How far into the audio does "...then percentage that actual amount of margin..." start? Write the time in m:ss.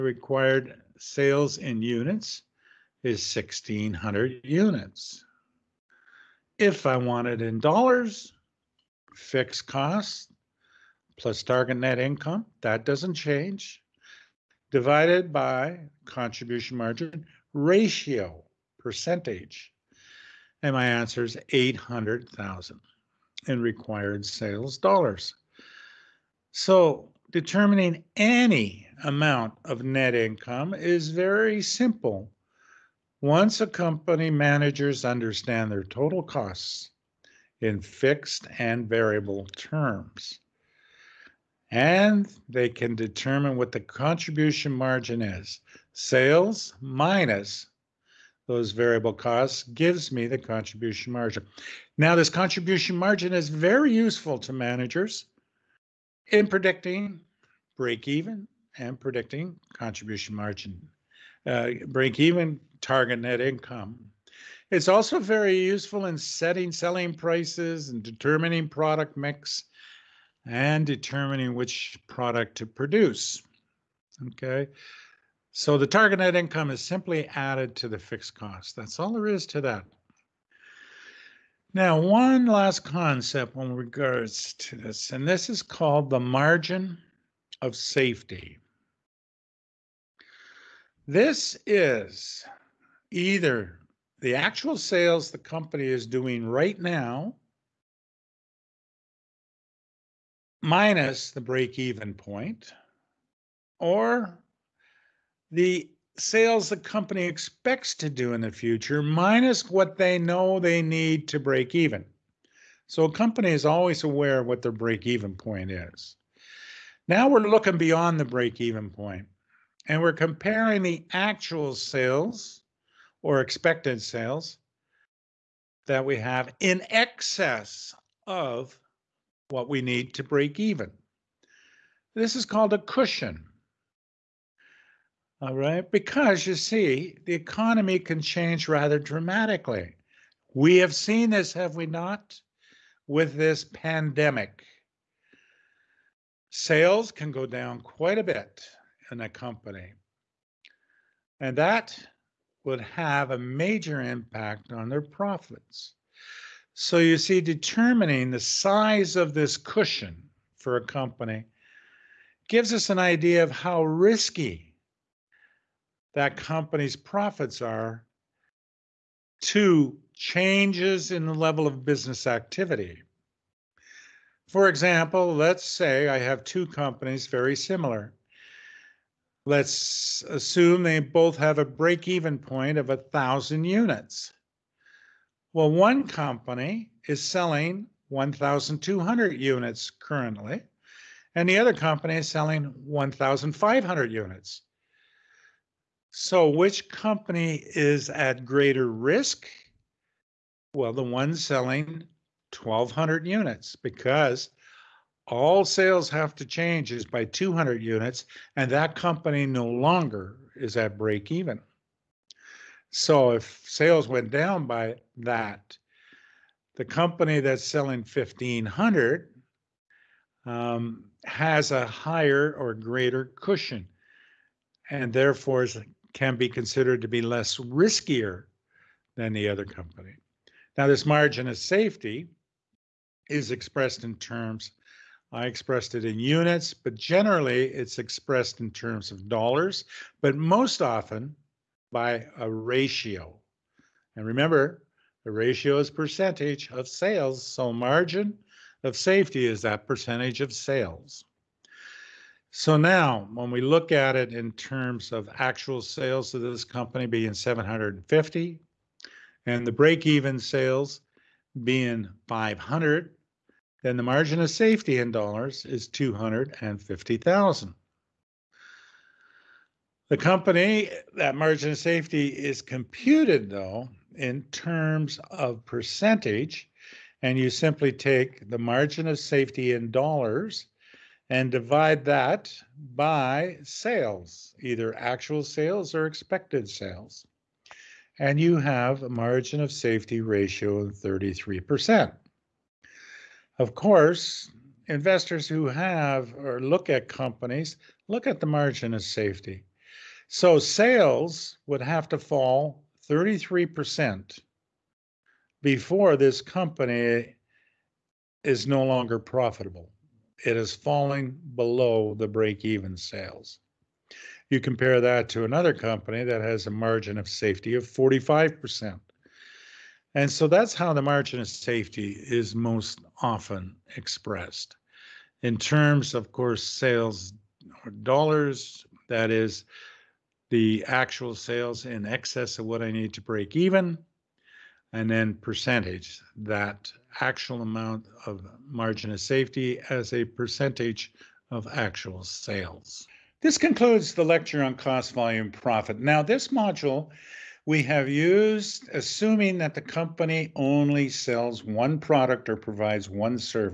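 5:35.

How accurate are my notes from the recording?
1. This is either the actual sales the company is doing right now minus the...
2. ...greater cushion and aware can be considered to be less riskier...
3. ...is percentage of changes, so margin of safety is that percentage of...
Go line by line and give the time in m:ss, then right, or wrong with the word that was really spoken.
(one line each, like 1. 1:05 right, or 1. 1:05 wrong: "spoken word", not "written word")
1. 1:31 right
2. 3:42 wrong: "therefore", not "aware"
3. 4:05 wrong: "sales", not "changes".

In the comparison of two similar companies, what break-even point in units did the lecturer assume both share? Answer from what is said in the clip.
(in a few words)
1,000 units.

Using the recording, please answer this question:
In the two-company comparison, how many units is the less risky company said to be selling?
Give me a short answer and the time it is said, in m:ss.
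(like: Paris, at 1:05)
1,500 units, at 3:12.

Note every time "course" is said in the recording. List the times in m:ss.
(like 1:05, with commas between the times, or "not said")
4:53, 5:26.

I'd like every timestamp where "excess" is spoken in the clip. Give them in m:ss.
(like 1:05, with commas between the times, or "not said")
2:06, 5:32.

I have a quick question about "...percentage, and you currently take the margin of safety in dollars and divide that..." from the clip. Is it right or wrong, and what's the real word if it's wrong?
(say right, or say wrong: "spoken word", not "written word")
wrong: "simply", not "currently".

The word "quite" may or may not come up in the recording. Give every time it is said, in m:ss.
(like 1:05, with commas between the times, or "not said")
2:27.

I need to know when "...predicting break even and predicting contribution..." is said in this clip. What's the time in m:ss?
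0:56.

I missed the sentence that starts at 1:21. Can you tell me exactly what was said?
Now, one last concept in regards to this, and this is called the margin of safety.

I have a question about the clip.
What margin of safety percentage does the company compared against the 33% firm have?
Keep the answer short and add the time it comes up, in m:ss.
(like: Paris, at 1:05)
45%, at 5:17.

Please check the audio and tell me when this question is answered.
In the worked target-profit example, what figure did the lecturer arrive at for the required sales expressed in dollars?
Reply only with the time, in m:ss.
0:21.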